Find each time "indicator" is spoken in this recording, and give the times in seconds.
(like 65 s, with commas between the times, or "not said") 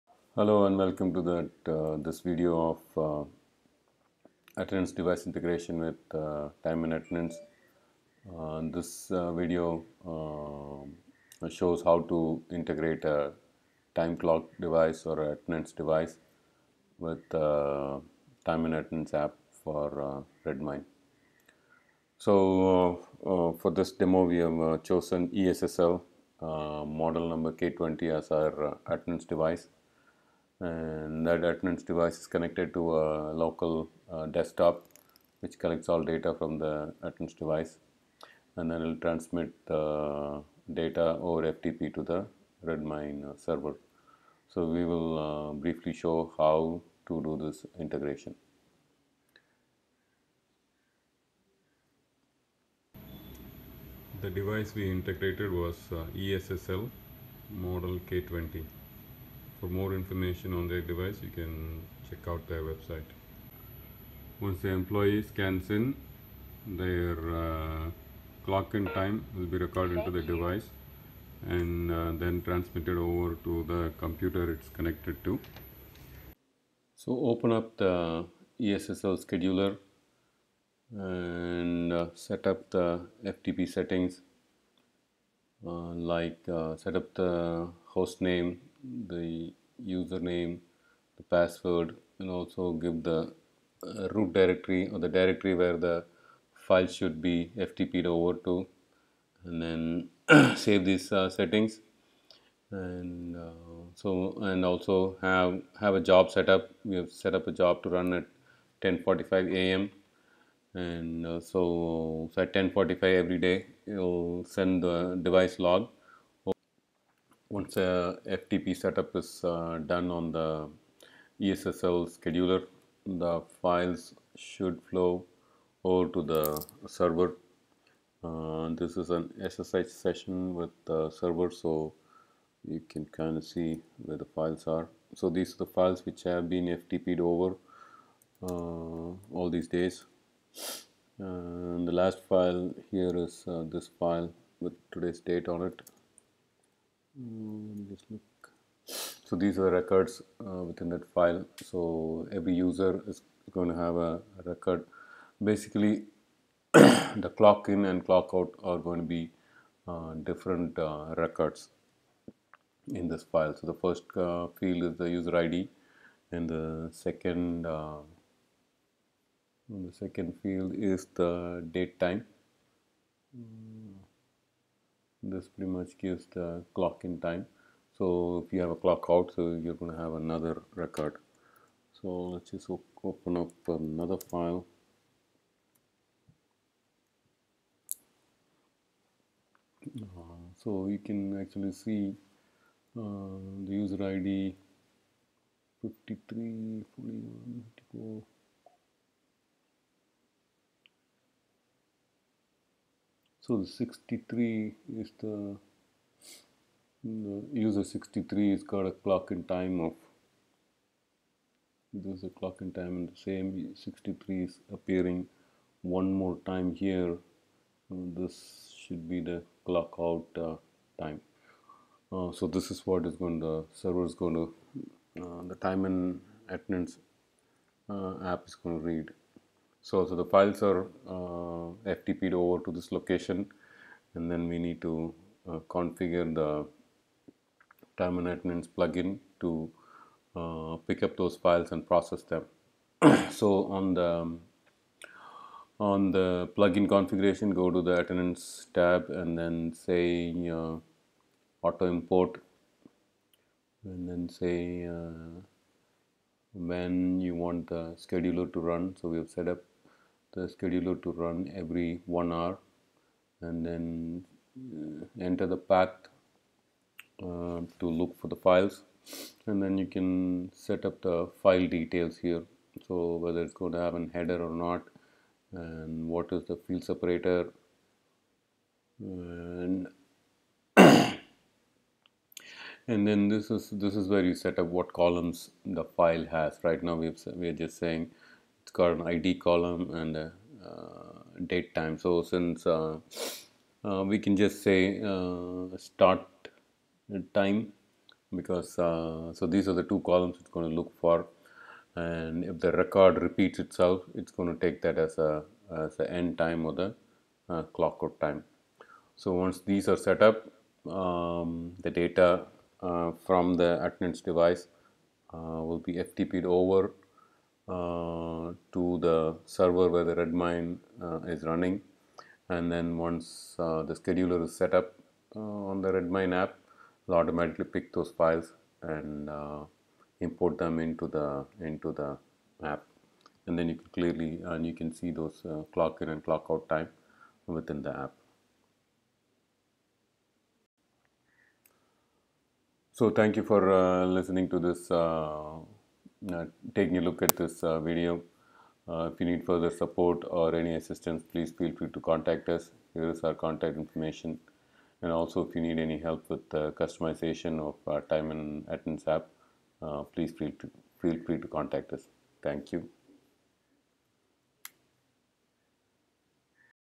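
not said.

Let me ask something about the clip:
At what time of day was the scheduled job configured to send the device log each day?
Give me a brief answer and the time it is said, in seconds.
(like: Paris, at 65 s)
10:45 a.m., at 108 s.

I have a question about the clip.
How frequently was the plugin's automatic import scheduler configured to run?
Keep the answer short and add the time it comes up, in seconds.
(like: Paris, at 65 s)
every one hour, at 261 s.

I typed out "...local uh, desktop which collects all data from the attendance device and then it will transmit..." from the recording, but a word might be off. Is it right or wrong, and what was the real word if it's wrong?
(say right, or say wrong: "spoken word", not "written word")
right.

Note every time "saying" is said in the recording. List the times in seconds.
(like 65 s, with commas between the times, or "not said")
287 s.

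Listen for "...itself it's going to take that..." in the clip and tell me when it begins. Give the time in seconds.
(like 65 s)
303 s.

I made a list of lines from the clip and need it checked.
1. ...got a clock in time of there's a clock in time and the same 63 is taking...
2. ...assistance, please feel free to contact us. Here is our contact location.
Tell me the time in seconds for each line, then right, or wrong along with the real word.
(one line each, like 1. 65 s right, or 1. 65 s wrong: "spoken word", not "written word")
1. 208 s wrong: "appearing", not "taking"
2. 350 s wrong: "information", not "location".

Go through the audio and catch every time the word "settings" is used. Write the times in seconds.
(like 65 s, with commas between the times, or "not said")
83 s, 101 s.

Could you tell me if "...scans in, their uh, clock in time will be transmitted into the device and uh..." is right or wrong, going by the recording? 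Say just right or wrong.
wrong.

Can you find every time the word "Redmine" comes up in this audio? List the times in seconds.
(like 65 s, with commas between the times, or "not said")
20 s, 42 s, 320 s, 325 s.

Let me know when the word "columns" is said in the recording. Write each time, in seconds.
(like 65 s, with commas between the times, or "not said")
284 s, 289 s, 300 s.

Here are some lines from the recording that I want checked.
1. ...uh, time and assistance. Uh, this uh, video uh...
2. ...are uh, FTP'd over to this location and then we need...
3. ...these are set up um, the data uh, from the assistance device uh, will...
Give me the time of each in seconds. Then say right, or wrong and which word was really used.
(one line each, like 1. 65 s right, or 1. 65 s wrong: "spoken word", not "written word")
1. 6 s wrong: "attendance", not "assistance"
2. 230 s right
3. 309 s wrong: "attendance", not "assistance".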